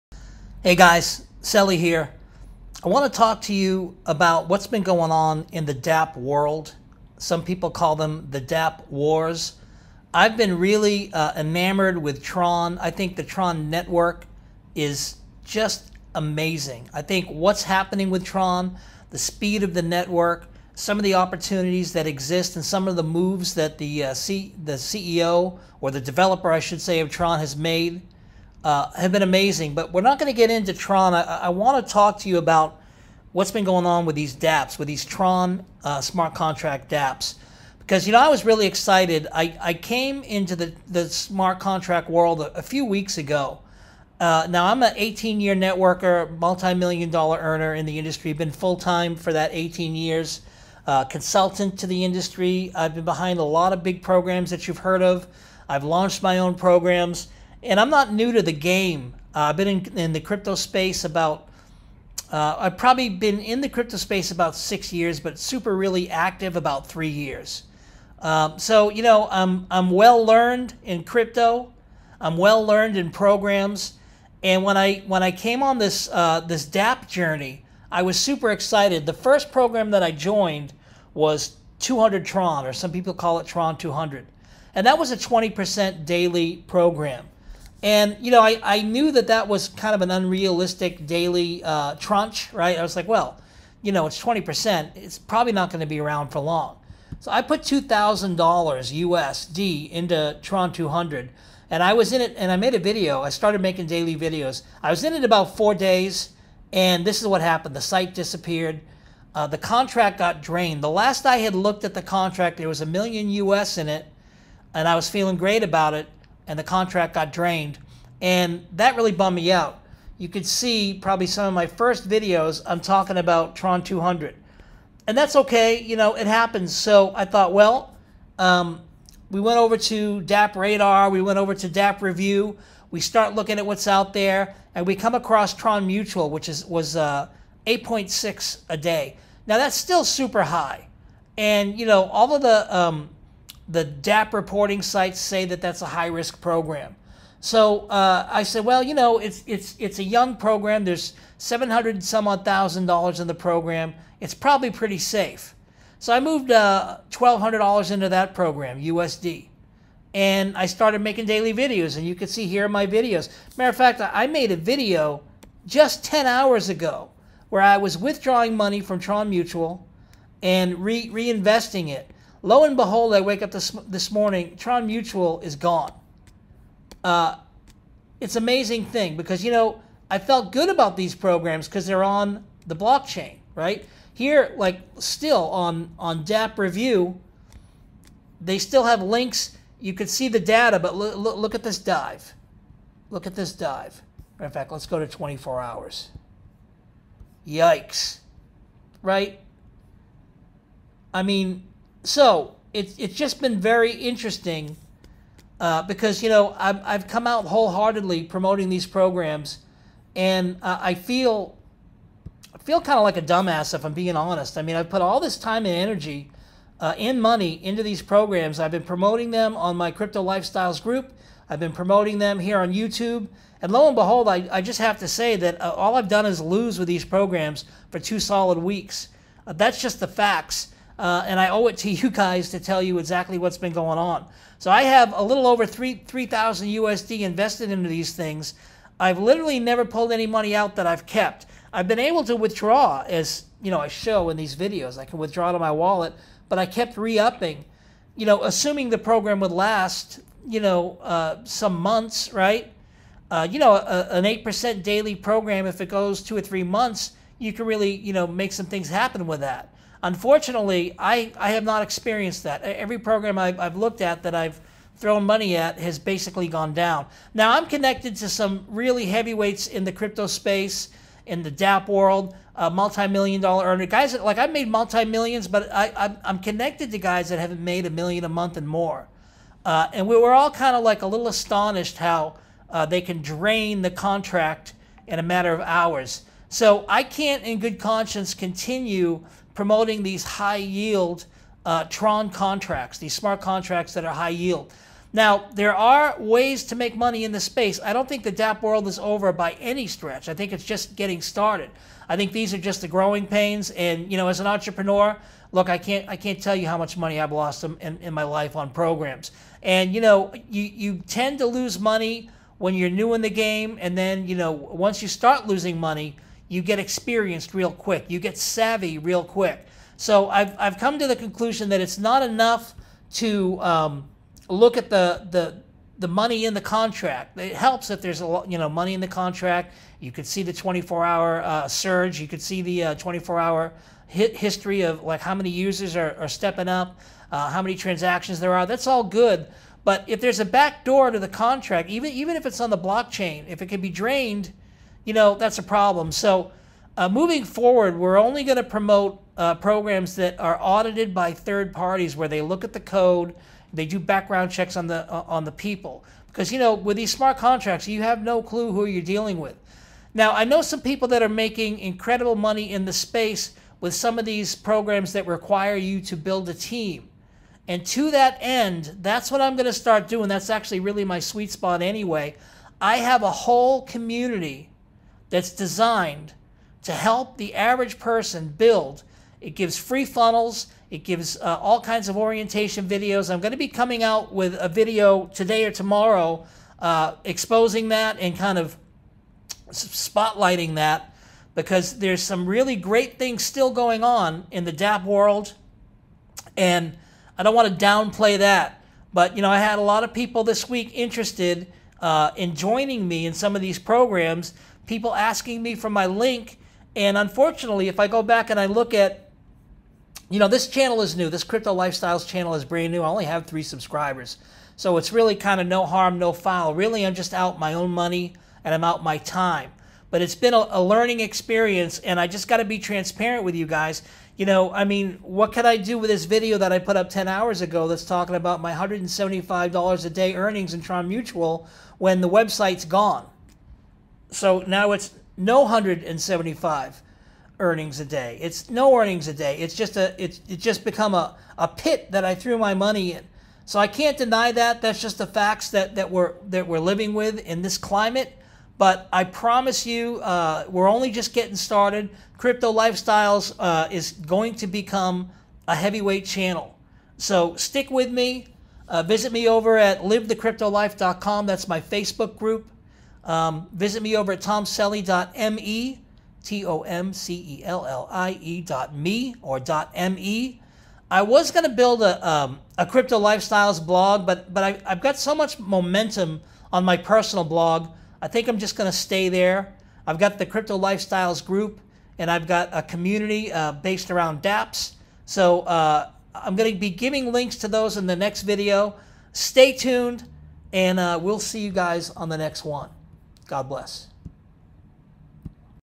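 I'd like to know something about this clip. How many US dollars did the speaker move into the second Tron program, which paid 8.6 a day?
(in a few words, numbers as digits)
$1,200.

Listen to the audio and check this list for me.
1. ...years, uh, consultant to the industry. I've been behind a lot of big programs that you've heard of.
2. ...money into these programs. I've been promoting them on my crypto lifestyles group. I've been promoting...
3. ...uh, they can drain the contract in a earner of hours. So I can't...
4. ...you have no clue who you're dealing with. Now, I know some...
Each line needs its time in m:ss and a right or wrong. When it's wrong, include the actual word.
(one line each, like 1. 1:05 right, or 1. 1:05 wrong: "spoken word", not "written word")
1. 0:49 right
2. 3:37 right
3. 4:42 wrong: "matter", not "earner"
4. 5:57 right.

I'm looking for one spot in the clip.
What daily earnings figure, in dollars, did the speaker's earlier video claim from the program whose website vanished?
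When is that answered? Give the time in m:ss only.
7:08.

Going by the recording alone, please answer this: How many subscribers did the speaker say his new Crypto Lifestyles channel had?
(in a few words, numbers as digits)
3.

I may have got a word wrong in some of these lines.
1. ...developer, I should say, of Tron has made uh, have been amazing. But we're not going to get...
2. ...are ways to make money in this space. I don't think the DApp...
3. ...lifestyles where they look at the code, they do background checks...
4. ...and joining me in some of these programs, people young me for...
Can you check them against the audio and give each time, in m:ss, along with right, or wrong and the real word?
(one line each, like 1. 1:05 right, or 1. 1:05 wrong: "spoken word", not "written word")
1. 0:25 right
2. 4:55 right
3. 5:51 wrong: "parties", not "lifestyles"
4. 6:42 wrong: "asking", not "young".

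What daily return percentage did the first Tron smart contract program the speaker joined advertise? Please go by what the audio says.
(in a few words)
20%.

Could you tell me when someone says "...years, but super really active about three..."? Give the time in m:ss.
1:04.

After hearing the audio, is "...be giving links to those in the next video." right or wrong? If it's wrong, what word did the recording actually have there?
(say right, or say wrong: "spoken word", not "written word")
right.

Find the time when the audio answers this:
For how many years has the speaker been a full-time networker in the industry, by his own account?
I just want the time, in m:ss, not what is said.
0:44.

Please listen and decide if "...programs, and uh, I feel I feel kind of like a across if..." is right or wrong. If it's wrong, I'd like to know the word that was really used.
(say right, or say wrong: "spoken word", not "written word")
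wrong: "dumbass", not "across".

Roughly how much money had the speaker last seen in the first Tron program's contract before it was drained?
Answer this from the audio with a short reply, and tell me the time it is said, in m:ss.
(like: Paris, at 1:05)
a million US, at 1:52.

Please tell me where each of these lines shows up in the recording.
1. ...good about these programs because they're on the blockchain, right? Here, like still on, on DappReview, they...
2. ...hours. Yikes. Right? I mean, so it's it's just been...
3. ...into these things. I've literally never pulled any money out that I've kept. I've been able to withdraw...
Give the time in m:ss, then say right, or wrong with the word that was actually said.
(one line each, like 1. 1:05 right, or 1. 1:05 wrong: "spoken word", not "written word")
1. 3:00 right
2. 3:15 right
3. 3:57 right.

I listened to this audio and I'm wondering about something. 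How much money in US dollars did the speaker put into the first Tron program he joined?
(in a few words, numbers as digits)
$2,000.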